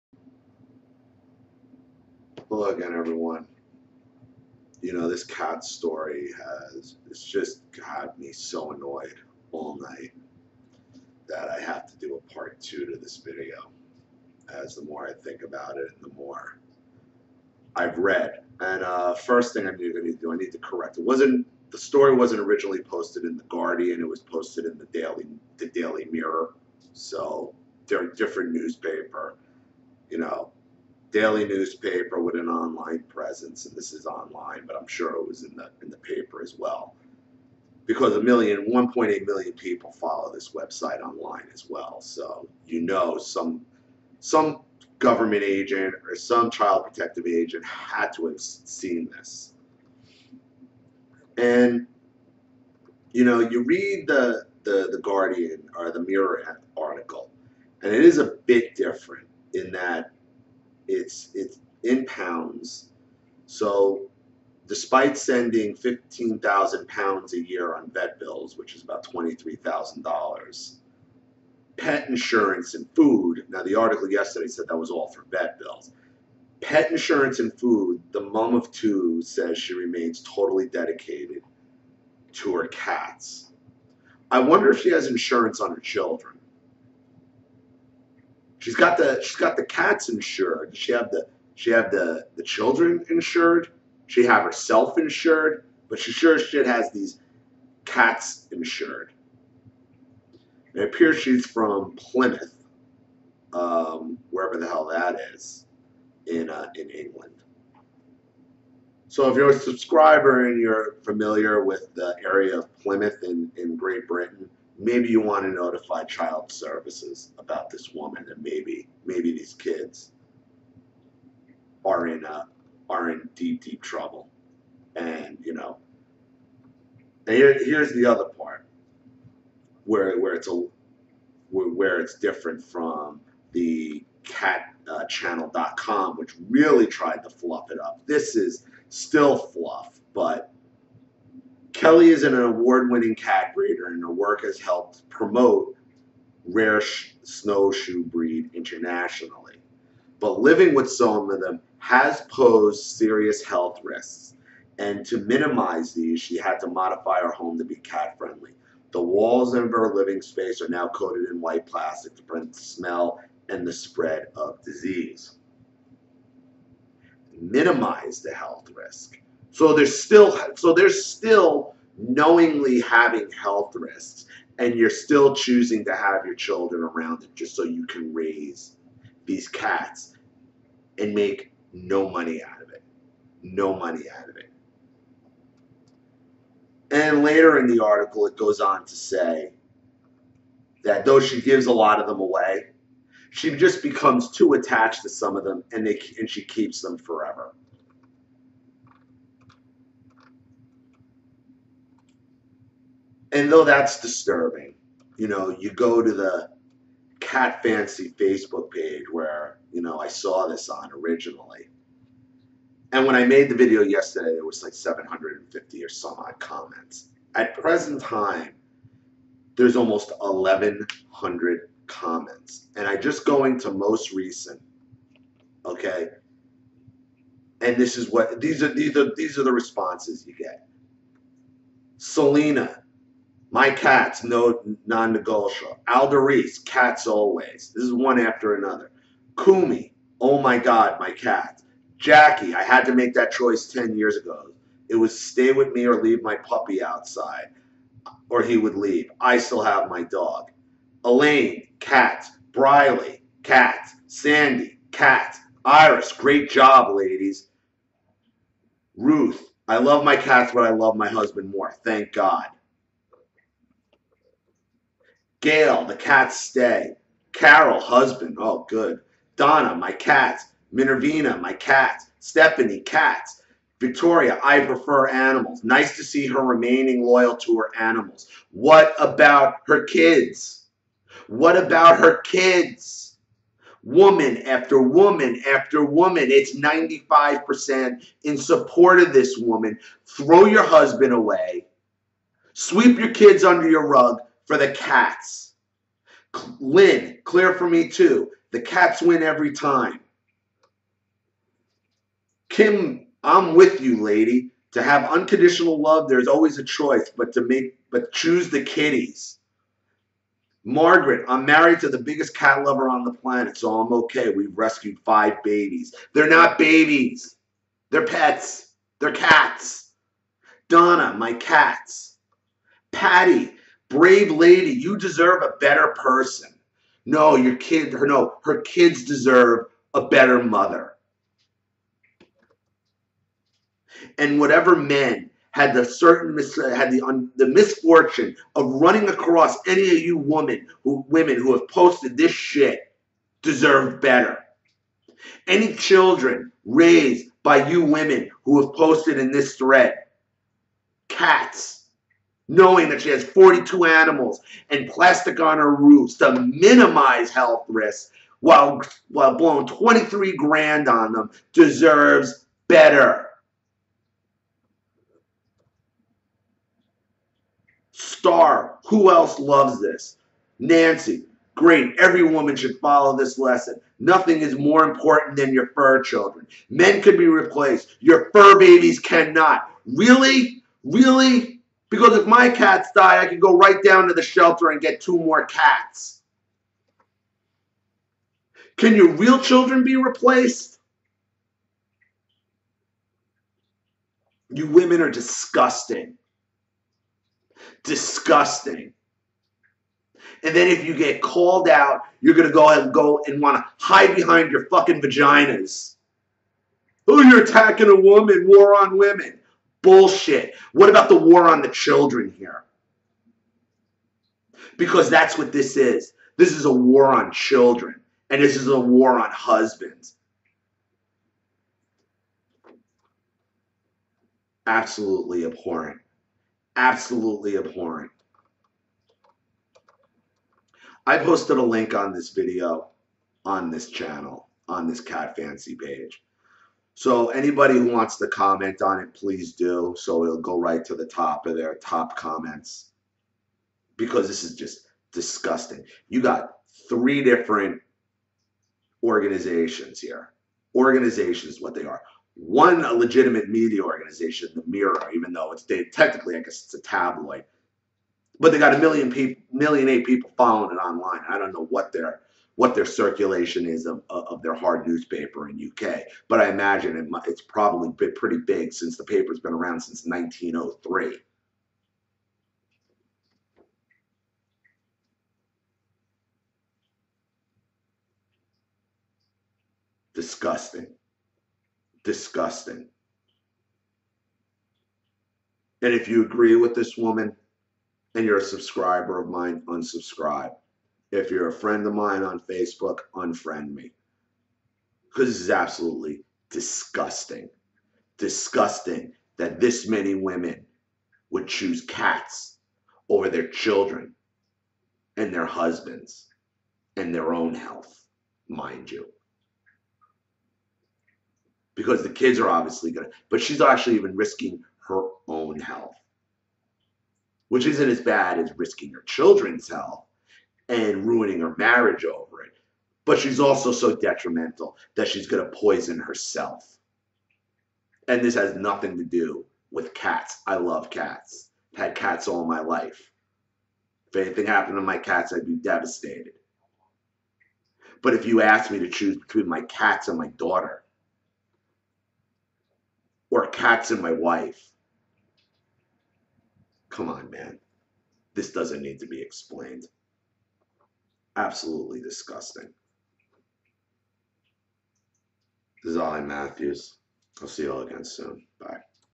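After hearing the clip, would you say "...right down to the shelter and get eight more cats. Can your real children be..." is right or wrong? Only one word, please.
wrong.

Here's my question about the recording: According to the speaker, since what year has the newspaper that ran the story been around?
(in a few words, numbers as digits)
1903.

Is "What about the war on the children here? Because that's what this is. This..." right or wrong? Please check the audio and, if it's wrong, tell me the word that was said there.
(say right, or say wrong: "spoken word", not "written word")
right.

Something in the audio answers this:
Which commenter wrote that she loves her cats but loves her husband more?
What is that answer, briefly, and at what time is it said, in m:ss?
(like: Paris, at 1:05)
Ruth, at 4:18.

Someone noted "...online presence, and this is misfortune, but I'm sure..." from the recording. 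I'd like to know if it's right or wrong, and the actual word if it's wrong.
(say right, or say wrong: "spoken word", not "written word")
wrong: "online", not "misfortune".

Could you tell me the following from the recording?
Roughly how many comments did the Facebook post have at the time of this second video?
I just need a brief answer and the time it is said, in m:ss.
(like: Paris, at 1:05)
Almost 1,100, at 3:39.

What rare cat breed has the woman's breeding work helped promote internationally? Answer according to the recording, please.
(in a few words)
Snowshoe.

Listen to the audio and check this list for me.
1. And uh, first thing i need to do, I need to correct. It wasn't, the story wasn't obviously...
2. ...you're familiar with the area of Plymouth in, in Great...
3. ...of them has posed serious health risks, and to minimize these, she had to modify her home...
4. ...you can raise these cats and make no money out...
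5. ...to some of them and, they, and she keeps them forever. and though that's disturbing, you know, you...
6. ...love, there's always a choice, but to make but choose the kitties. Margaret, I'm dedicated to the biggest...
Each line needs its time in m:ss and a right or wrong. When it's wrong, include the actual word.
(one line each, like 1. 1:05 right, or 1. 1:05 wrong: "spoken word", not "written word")
1. 0:18 wrong: "originally", not "obviously"
2. 1:50 right
3. 2:31 right
4. 2:57 right
5. 3:15 right
6. 5:05 wrong: "married", not "dedicated".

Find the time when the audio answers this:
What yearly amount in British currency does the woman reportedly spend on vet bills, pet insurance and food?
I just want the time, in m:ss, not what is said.
1:05.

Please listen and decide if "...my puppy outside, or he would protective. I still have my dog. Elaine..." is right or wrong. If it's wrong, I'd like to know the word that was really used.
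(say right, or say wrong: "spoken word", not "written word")
wrong: "leave", not "protective".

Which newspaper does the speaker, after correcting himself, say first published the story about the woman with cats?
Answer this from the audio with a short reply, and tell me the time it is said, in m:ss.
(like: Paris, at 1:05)
Daily Mirror, at 0:25.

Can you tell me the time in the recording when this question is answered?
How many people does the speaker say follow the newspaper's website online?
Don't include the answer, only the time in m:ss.
0:38.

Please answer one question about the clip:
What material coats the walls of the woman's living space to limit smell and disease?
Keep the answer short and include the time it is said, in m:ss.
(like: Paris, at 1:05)
White plastic, at 2:41.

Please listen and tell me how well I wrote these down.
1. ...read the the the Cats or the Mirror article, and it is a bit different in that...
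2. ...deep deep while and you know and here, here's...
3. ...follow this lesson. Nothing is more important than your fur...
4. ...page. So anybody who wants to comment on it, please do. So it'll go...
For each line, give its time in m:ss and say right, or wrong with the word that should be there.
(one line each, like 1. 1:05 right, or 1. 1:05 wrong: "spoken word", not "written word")
1. 0:53 wrong: "Guardian", not "Cats"
2. 2:03 wrong: "trouble", not "while"
3. 6:12 right
4. 7:15 right.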